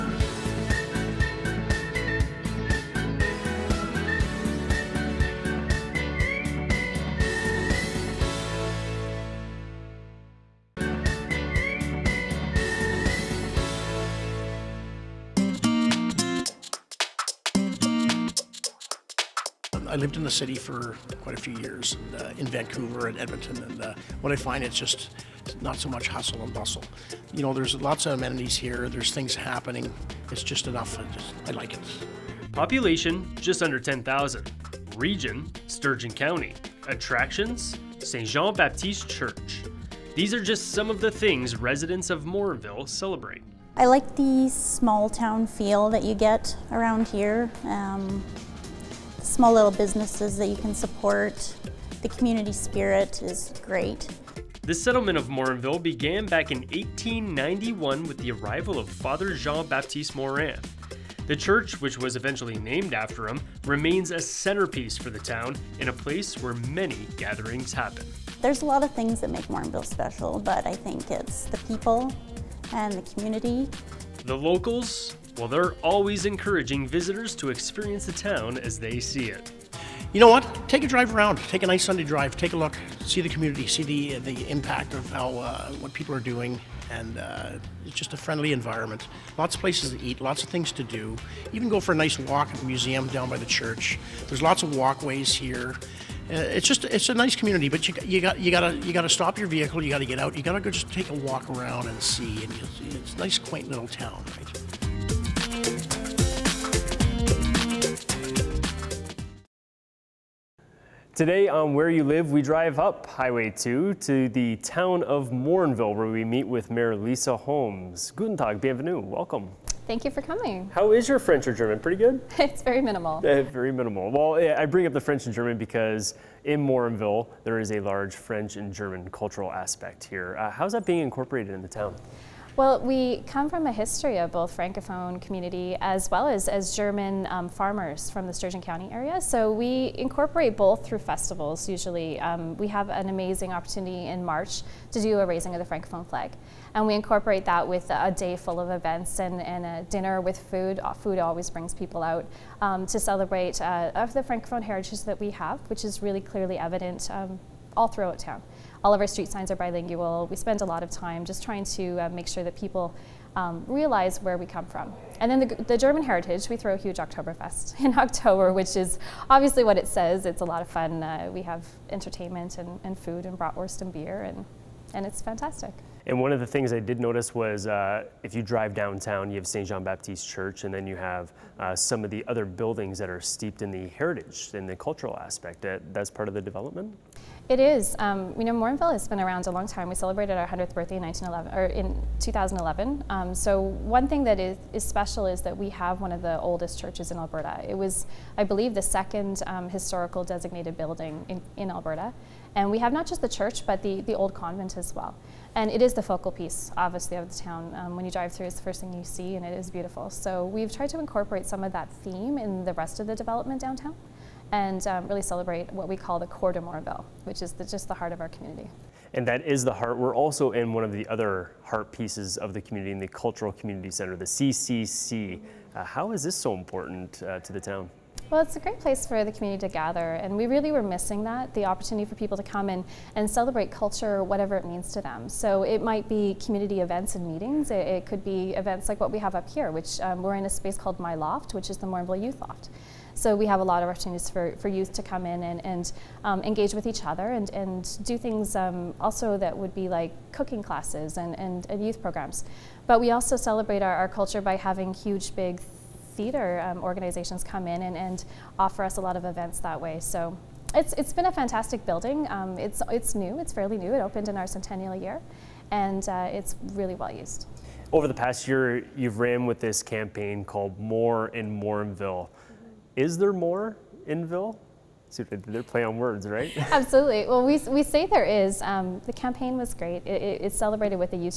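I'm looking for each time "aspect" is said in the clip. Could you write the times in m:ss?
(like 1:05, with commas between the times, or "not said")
2:09, 3:05.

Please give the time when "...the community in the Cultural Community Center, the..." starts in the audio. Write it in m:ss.
3:42.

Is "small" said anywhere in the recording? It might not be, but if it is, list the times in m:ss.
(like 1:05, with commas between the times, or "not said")
0:44, 0:49.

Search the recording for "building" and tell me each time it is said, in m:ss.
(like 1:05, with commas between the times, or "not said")
3:02, 3:20, 4:21.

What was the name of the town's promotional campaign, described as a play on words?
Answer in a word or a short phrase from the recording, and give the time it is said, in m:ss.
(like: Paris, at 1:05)
More in Morinville, at 4:30.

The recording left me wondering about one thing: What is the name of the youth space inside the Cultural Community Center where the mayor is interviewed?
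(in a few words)
My Loft.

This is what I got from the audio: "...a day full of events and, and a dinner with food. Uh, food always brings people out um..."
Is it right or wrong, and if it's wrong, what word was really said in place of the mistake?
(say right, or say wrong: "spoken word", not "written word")
right.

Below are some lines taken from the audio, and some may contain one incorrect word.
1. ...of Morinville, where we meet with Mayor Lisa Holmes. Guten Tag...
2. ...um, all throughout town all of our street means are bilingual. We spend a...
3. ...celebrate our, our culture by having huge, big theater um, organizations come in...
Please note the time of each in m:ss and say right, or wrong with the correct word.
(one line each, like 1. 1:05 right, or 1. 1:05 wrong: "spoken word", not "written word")
1. 1:55 right
2. 2:37 wrong: "signs", not "means"
3. 4:13 right.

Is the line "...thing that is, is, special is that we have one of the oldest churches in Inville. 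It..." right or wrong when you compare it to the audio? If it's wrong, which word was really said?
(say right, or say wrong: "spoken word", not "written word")
wrong: "Alberta", not "Inville".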